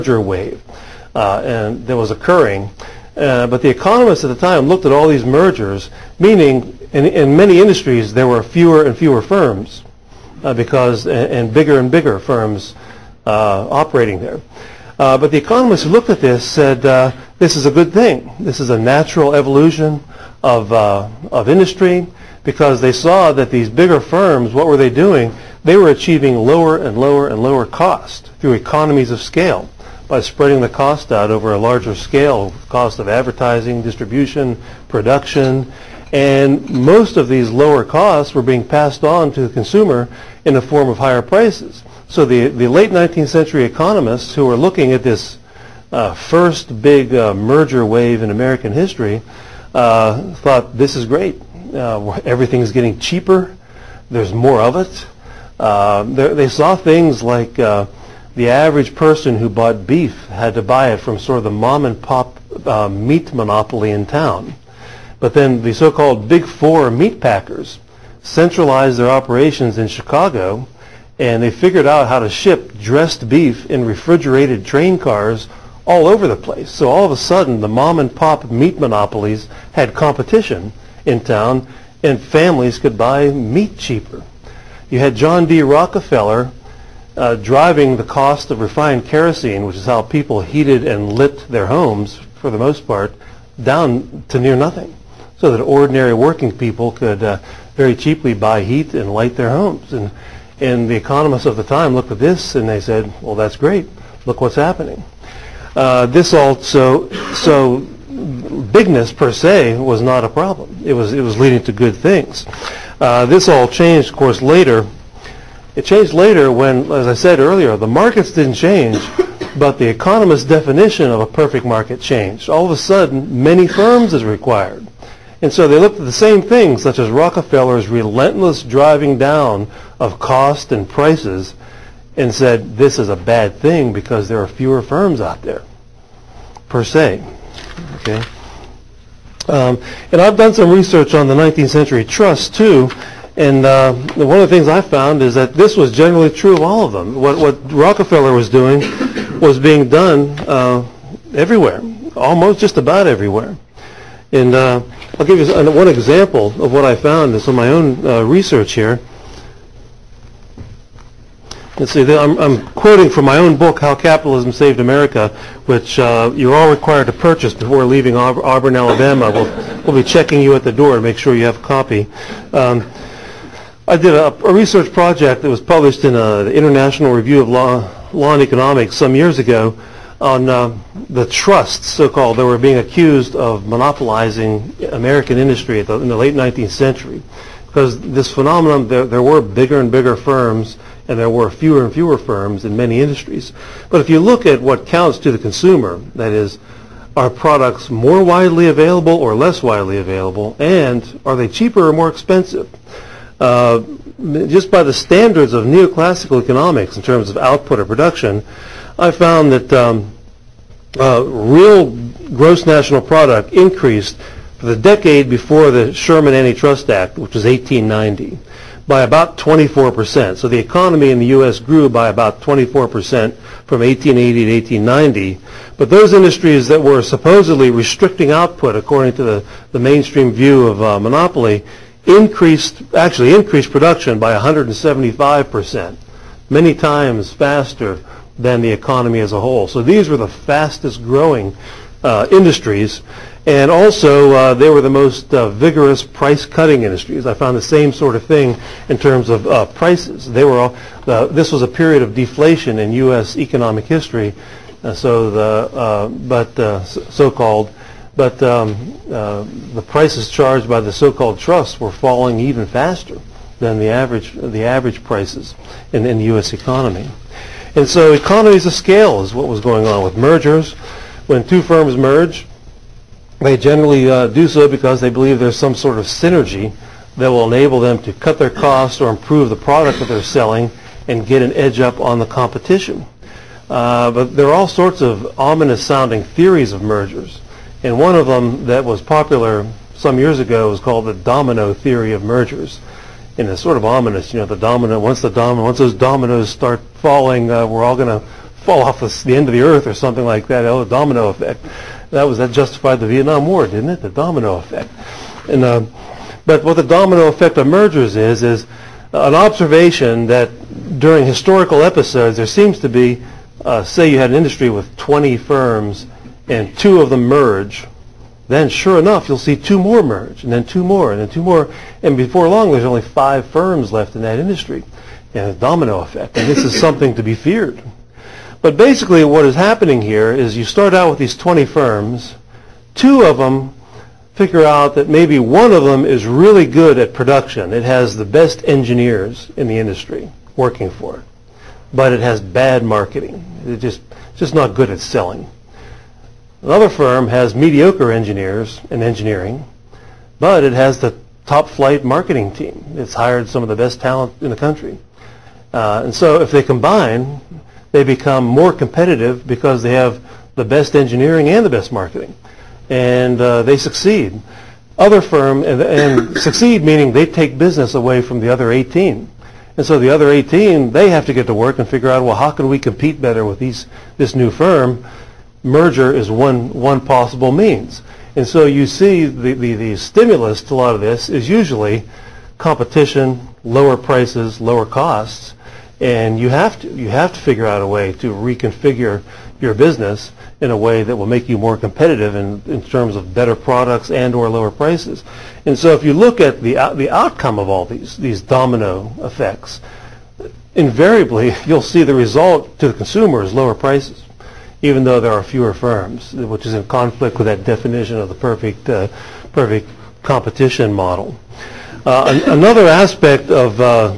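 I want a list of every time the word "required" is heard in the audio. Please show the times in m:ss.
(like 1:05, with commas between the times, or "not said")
2:04, 2:46.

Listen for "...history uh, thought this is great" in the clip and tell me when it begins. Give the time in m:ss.
0:48.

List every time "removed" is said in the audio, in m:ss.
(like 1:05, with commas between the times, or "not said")
not said.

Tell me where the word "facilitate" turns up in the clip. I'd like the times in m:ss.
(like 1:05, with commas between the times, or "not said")
not said.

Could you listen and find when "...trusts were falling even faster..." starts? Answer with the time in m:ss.
4:21.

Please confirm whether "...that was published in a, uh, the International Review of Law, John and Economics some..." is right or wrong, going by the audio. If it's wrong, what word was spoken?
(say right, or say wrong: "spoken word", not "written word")
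wrong: "Law", not "John".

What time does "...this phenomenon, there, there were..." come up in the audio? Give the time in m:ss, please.
3:07.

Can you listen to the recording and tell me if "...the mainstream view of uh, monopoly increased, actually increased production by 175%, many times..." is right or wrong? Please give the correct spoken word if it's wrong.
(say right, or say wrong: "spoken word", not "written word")
right.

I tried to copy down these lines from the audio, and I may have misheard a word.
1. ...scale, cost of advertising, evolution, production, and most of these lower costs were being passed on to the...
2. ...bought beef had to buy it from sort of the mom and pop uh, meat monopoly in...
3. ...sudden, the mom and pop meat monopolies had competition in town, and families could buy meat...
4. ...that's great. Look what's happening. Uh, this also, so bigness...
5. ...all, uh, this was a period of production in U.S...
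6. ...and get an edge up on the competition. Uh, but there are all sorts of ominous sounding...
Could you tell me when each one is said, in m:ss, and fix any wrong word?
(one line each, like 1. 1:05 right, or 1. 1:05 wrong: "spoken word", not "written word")
1. 0:31 wrong: "distribution", not "evolution"
2. 0:59 right
3. 1:17 right
4. 1:43 right
5. 4:10 wrong: "deflation", not "production"
6. 4:41 right.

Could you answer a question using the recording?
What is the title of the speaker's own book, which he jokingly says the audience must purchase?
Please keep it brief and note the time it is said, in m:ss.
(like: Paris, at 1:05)
How Capitalism Saved America, at 2:43.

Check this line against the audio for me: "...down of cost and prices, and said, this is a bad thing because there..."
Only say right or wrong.
right.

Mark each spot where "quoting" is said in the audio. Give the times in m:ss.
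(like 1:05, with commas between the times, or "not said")
2:42.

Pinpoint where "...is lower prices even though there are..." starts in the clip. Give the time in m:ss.
6:43.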